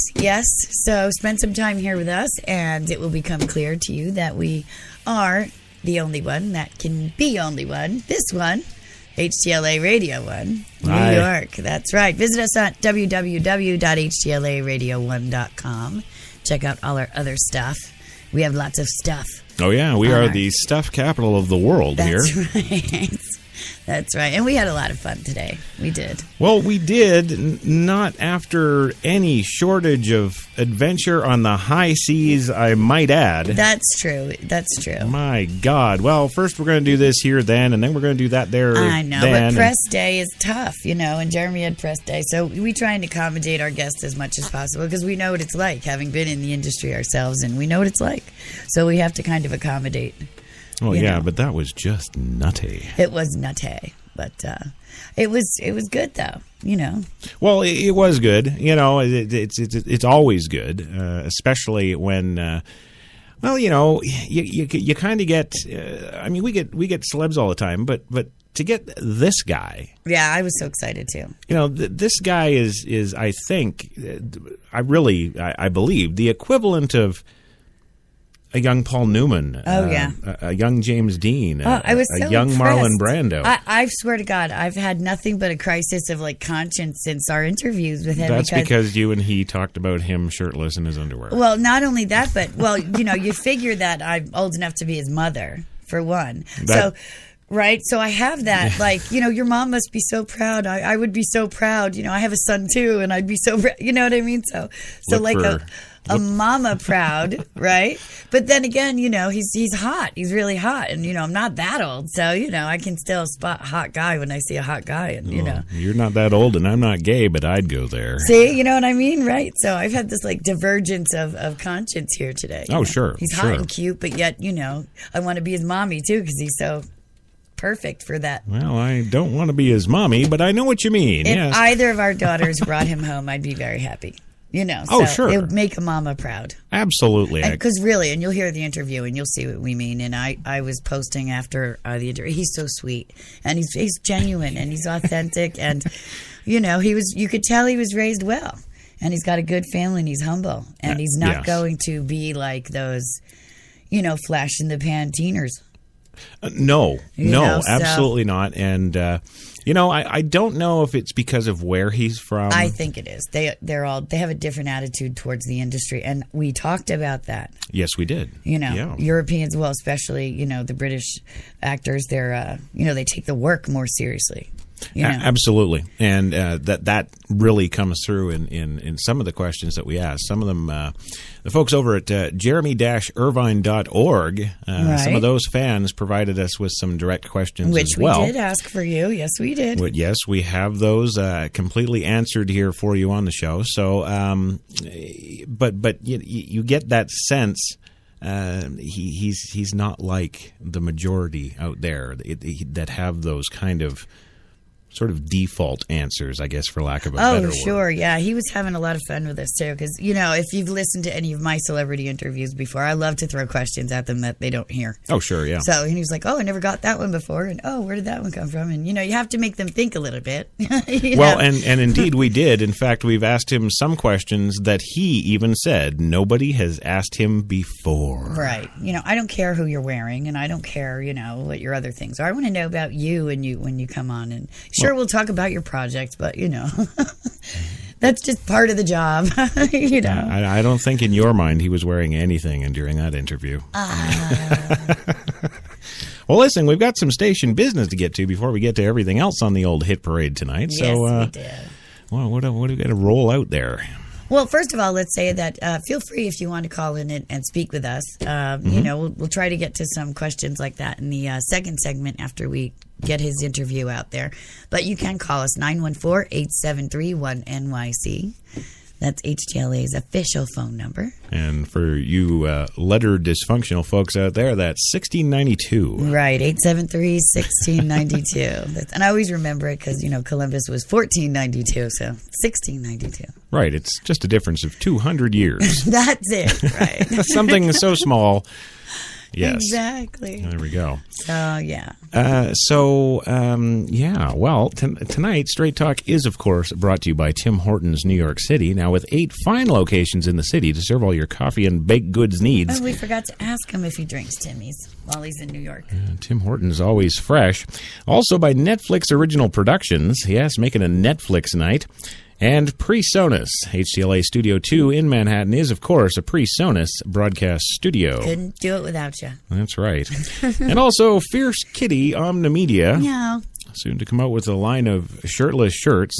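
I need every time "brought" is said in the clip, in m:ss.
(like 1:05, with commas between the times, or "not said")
2:12, 4:56.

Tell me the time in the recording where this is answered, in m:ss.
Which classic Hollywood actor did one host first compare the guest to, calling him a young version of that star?
1:18.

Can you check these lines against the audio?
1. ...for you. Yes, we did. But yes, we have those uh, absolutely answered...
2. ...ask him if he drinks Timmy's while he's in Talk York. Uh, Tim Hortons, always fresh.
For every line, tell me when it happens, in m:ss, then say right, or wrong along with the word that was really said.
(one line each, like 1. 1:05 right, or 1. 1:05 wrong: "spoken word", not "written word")
1. 3:08 wrong: "completely", not "absolutely"
2. 5:03 wrong: "New", not "Talk".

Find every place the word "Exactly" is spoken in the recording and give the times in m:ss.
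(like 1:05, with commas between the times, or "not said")
4:49.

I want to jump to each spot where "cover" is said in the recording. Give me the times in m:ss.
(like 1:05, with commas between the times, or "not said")
not said.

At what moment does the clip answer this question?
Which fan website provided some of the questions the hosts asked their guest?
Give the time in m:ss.
3:02.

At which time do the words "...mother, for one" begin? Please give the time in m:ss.
1:35.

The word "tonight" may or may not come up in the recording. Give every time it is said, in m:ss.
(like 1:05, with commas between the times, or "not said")
4:10, 4:55.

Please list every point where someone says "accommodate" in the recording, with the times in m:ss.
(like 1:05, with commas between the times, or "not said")
0:43, 0:49.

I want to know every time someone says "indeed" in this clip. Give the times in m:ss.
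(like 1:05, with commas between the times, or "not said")
3:41.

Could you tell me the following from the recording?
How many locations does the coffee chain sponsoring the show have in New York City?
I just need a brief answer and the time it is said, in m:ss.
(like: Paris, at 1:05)
8, at 4:59.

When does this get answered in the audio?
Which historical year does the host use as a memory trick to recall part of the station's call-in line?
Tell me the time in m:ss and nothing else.
4:40.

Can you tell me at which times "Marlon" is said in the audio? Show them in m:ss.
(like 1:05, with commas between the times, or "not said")
1:22.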